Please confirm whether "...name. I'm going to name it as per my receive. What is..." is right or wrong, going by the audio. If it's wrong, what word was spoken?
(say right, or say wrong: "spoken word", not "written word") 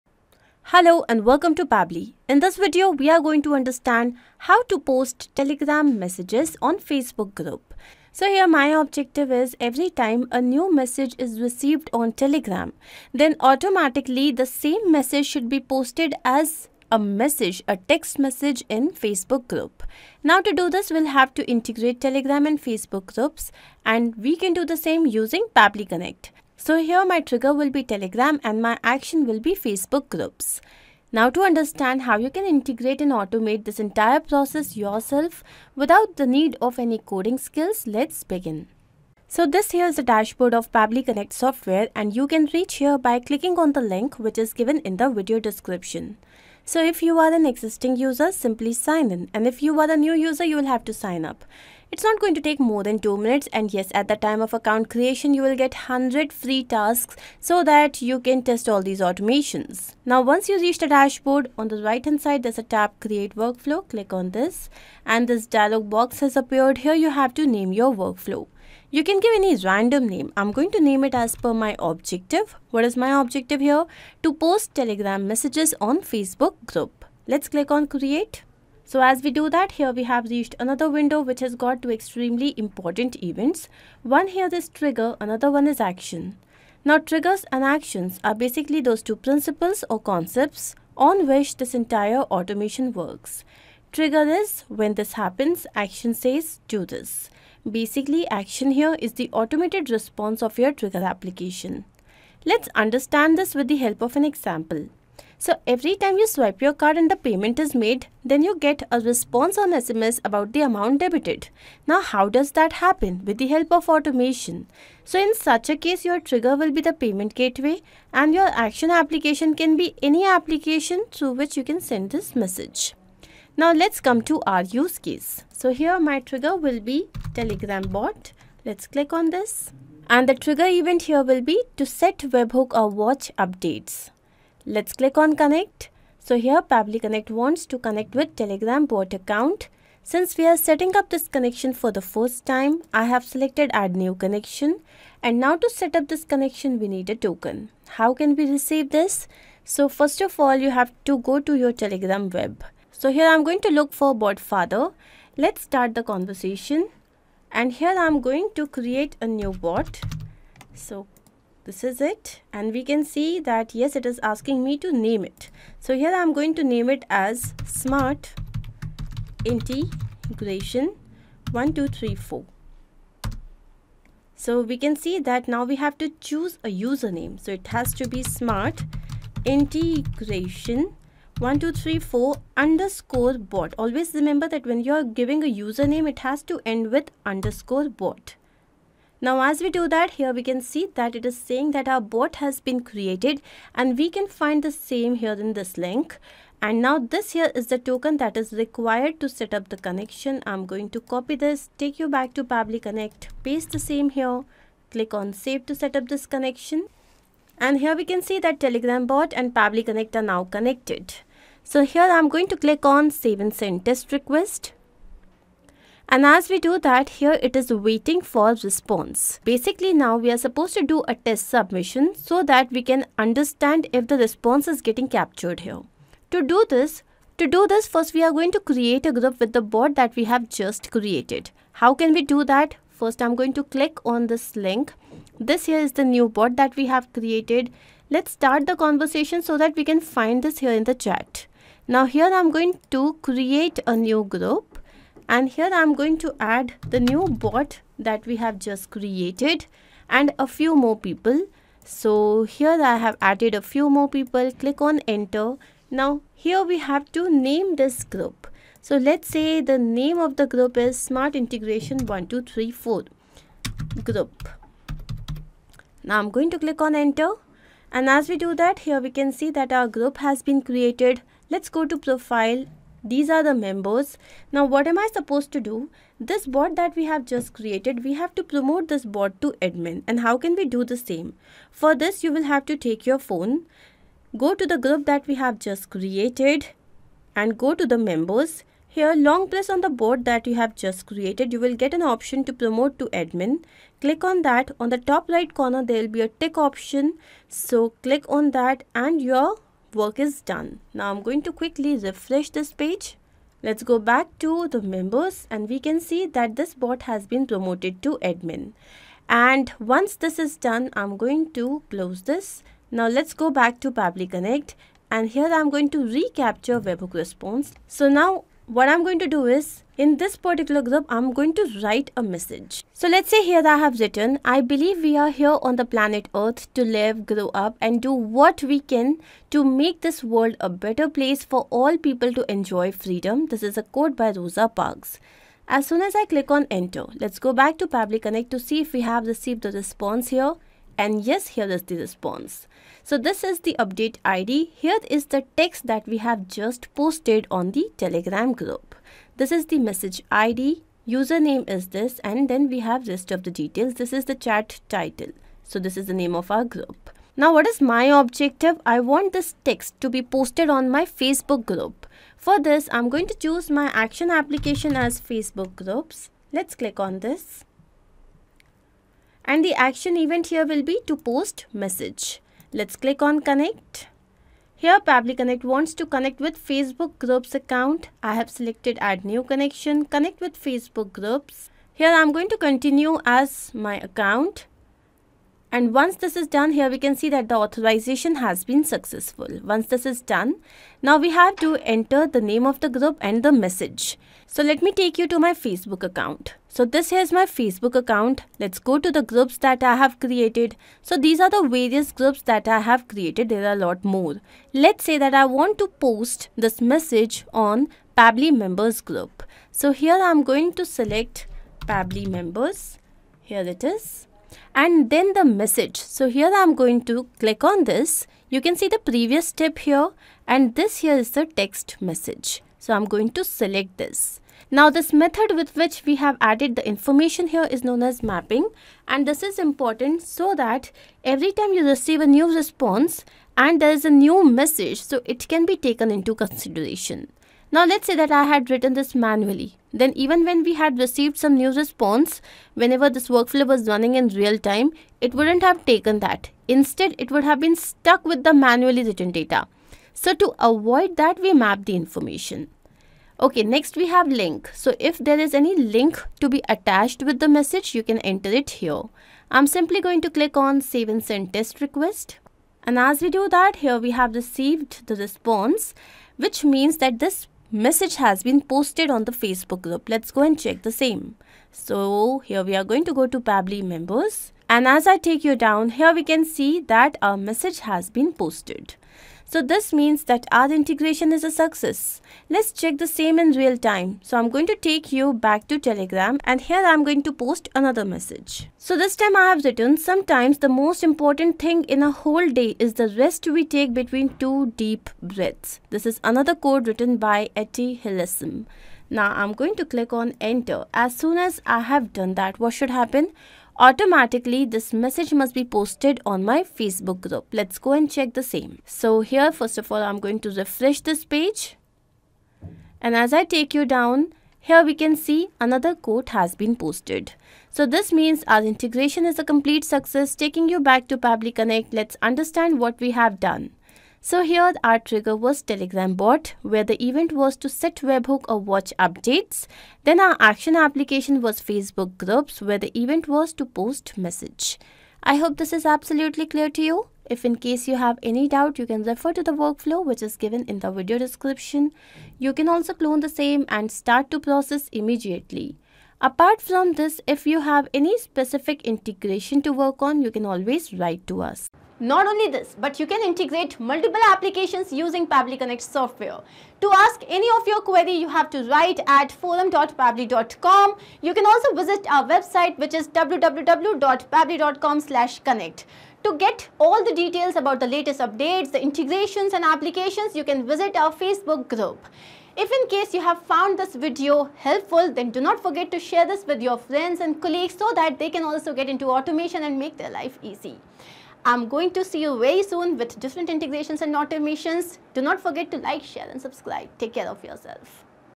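wrong: "objective", not "receive".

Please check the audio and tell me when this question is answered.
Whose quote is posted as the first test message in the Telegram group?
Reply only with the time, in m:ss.
5:34.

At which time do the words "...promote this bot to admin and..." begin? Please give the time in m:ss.
4:38.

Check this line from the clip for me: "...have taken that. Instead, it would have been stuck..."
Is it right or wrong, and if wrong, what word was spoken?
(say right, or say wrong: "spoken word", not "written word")
right.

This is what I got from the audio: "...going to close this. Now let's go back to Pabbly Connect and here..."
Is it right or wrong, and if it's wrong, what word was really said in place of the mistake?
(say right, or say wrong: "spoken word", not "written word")
right.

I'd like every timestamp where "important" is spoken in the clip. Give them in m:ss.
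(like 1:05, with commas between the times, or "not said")
1:22, 7:09, 8:11.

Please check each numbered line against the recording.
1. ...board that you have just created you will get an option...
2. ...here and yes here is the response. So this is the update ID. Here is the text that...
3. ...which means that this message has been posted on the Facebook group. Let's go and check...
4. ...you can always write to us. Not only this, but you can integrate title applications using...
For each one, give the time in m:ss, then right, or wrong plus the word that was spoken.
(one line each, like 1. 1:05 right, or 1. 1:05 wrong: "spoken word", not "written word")
1. 4:49 right
2. 5:40 right
3. 7:46 right
4. 9:10 wrong: "multiple", not "title".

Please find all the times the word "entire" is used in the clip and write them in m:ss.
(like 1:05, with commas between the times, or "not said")
0:33, 1:31.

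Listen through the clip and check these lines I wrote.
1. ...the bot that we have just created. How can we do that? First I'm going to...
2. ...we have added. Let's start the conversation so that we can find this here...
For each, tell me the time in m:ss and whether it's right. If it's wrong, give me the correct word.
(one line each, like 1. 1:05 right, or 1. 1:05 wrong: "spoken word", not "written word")
1. 3:49 right
2. 3:56 wrong: "created", not "added".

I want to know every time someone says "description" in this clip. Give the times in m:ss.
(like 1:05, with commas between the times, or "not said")
0:45, 9:01.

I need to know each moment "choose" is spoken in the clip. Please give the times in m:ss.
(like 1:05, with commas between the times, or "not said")
2:56, 6:03.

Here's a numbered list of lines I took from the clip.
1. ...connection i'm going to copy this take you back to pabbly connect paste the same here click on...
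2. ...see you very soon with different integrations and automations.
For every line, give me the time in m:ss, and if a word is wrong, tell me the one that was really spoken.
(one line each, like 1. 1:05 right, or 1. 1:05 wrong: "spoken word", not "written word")
1. 3:19 right
2. 9:42 right.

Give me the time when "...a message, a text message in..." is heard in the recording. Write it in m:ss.
0:16.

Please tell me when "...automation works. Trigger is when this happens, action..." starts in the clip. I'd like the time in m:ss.
1:32.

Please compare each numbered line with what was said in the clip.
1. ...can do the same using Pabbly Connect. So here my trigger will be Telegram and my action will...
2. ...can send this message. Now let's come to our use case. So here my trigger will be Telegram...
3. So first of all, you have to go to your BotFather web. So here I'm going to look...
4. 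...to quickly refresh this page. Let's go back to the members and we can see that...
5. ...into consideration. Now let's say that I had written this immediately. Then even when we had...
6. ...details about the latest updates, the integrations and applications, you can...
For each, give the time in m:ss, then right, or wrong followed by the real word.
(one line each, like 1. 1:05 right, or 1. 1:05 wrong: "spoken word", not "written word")
1. 0:24 right
2. 2:01 right
3. 2:29 wrong: "Telegram", not "BotFather"
4. 5:01 right
5. 7:16 wrong: "manually", not "immediately"
6. 9:27 right.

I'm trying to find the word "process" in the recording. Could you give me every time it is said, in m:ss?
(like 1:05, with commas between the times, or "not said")
0:34, 9:04.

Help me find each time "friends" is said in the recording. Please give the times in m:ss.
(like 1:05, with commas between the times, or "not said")
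9:36.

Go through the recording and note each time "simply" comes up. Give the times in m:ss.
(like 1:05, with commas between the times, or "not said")
0:48, 7:39.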